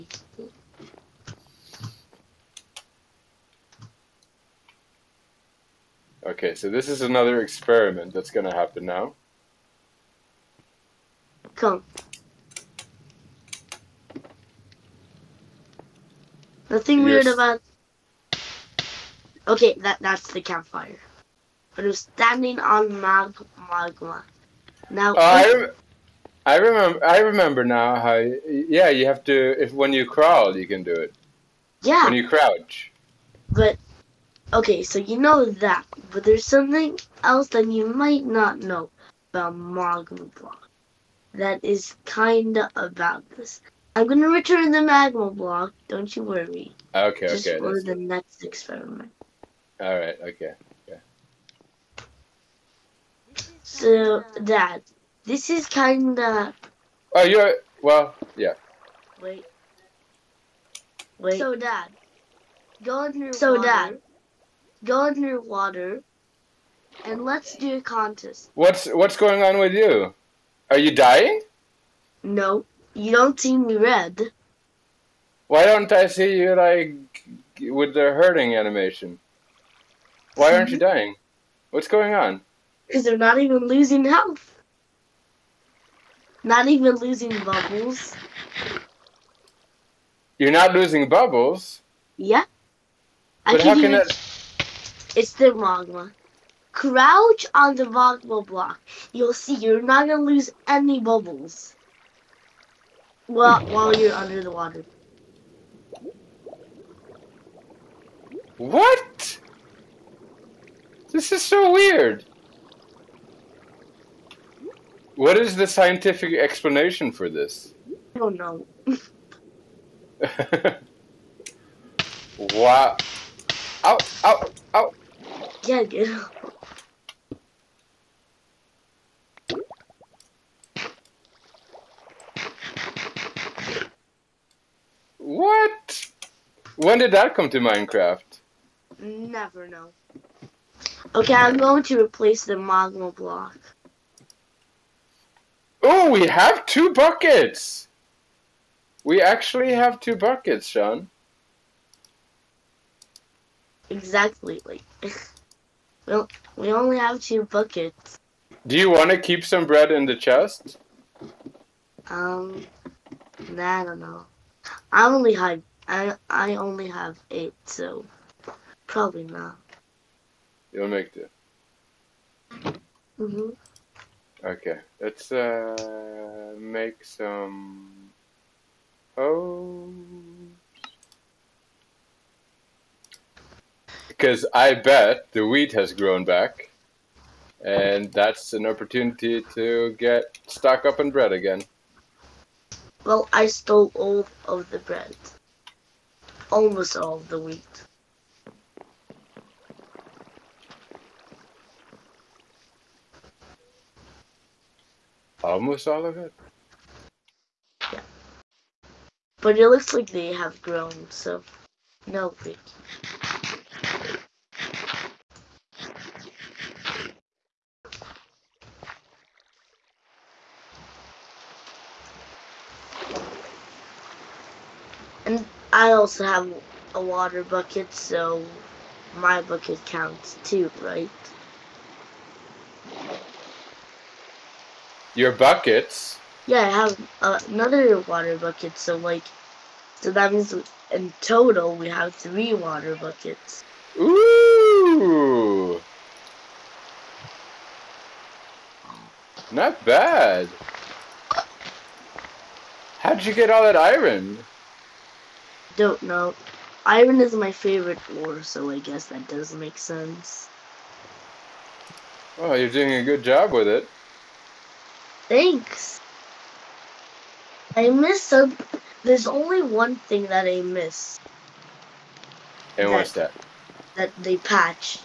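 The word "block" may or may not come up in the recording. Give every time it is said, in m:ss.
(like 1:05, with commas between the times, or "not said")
0:40, 0:45, 1:38, 2:23.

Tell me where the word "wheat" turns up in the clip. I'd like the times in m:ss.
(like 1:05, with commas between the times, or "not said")
3:05, 3:17, 3:32.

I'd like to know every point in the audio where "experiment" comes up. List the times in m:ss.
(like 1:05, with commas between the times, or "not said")
0:07, 0:48.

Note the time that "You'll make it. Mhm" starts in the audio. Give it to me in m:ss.
2:50.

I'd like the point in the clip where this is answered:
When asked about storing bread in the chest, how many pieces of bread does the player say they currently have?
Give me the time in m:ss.
2:47.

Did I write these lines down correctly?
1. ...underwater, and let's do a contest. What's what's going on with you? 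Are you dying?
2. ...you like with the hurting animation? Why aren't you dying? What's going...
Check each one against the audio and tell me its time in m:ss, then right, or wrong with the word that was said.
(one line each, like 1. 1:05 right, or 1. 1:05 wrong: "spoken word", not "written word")
1. 1:05 right
2. 1:16 right.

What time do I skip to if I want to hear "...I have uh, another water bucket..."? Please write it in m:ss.
3:56.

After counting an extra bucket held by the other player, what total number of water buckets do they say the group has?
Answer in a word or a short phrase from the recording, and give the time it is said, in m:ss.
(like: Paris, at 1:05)
3, at 4:02.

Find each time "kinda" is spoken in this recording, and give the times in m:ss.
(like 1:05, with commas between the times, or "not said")
0:42, 0:55.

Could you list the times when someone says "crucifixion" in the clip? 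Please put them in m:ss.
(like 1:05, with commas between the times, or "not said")
not said.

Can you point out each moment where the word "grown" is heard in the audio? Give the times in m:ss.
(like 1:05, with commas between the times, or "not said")
3:05, 3:30.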